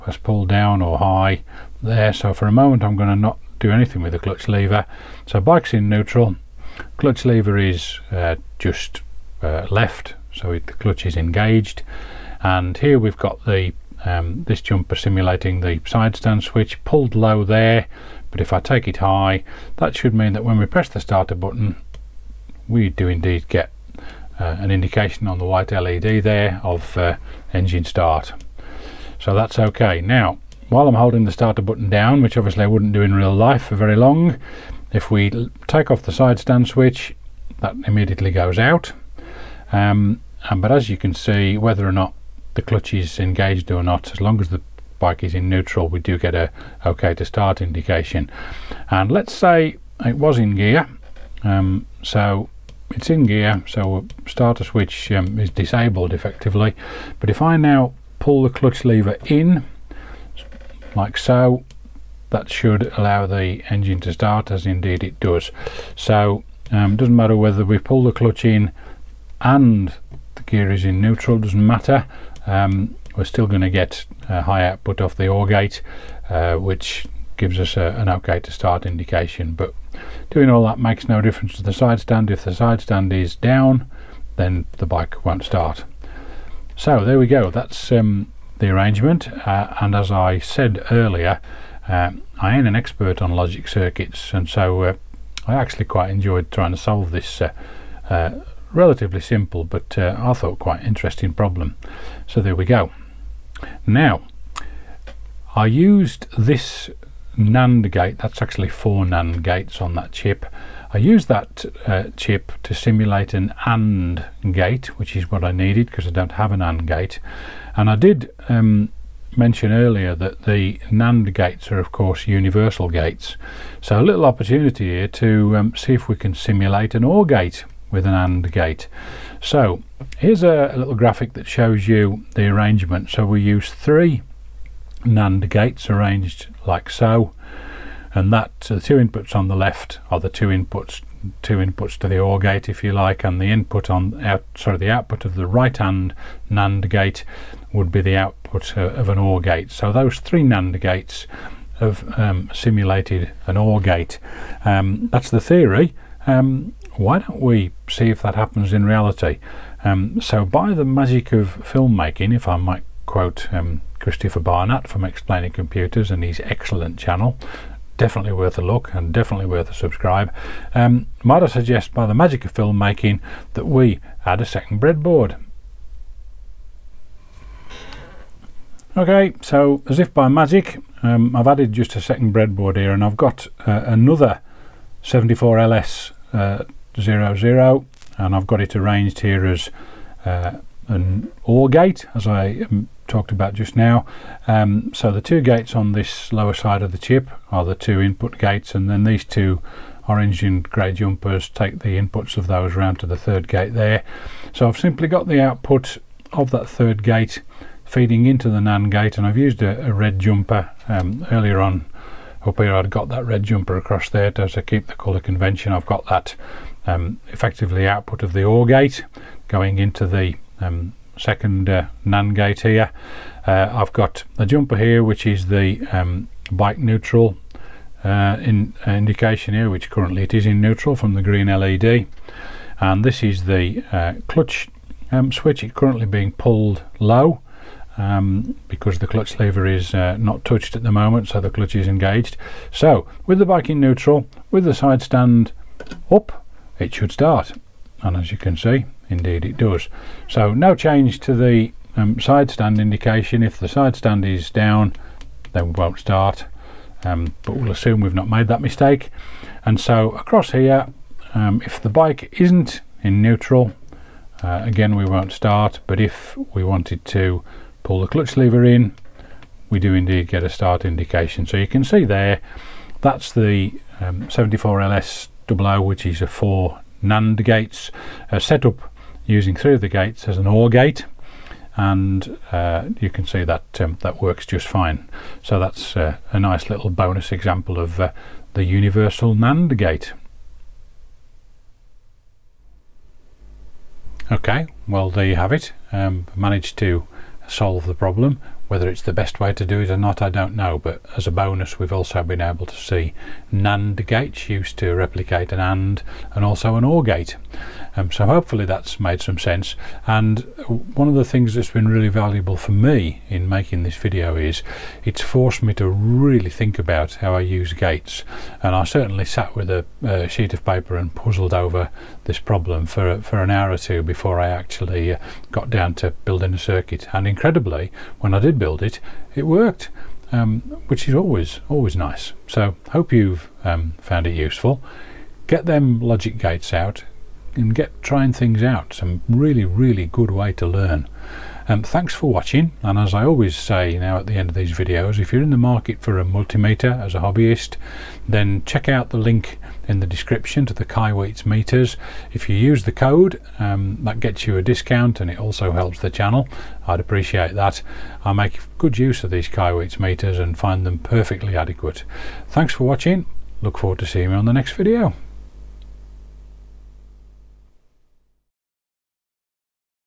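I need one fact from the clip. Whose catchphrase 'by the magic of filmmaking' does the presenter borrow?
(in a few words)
Christopher Barnatt.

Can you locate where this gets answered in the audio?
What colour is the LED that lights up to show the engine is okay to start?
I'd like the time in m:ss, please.
0:25.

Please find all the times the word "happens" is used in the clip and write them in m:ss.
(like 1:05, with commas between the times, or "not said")
2:38.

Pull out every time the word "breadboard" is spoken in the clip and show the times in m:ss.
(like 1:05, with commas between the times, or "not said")
2:54, 3:02.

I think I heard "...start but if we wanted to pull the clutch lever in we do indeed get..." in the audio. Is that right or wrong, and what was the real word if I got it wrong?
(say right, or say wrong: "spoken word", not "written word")
right.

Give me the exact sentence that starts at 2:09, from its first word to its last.
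So here's a, a little graphic that shows you the arrangement.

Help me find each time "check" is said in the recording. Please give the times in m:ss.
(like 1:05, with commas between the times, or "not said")
5:48.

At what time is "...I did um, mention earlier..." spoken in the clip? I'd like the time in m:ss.
1:57.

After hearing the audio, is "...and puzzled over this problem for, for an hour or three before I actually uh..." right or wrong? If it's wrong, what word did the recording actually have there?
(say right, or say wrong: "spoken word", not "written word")
wrong: "two", not "three".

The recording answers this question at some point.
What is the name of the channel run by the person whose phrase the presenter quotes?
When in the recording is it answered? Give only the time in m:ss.
2:45.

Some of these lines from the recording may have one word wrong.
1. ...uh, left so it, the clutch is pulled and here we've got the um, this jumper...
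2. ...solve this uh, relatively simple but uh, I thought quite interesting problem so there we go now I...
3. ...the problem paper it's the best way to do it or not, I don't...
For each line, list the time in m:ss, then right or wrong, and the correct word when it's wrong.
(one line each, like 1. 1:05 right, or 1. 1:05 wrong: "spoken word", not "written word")
1. 0:09 wrong: "engaged", not "pulled"
2. 1:36 right
3. 4:57 wrong: "whether", not "paper".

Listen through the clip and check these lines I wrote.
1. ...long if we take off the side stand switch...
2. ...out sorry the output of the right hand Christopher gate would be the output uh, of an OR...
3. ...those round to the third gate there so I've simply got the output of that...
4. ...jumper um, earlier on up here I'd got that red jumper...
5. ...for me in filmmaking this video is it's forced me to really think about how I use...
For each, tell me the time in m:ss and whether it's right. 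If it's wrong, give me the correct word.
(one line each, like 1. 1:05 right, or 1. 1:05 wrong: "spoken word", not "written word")
1. 0:33 right
2. 2:24 wrong: "NAND", not "Christopher"
3. 3:22 right
4. 3:30 right
5. 5:12 wrong: "making", not "filmmaking".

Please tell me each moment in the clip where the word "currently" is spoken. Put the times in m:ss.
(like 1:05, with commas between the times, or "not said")
3:49, 3:55.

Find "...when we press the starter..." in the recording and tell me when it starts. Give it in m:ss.
0:20.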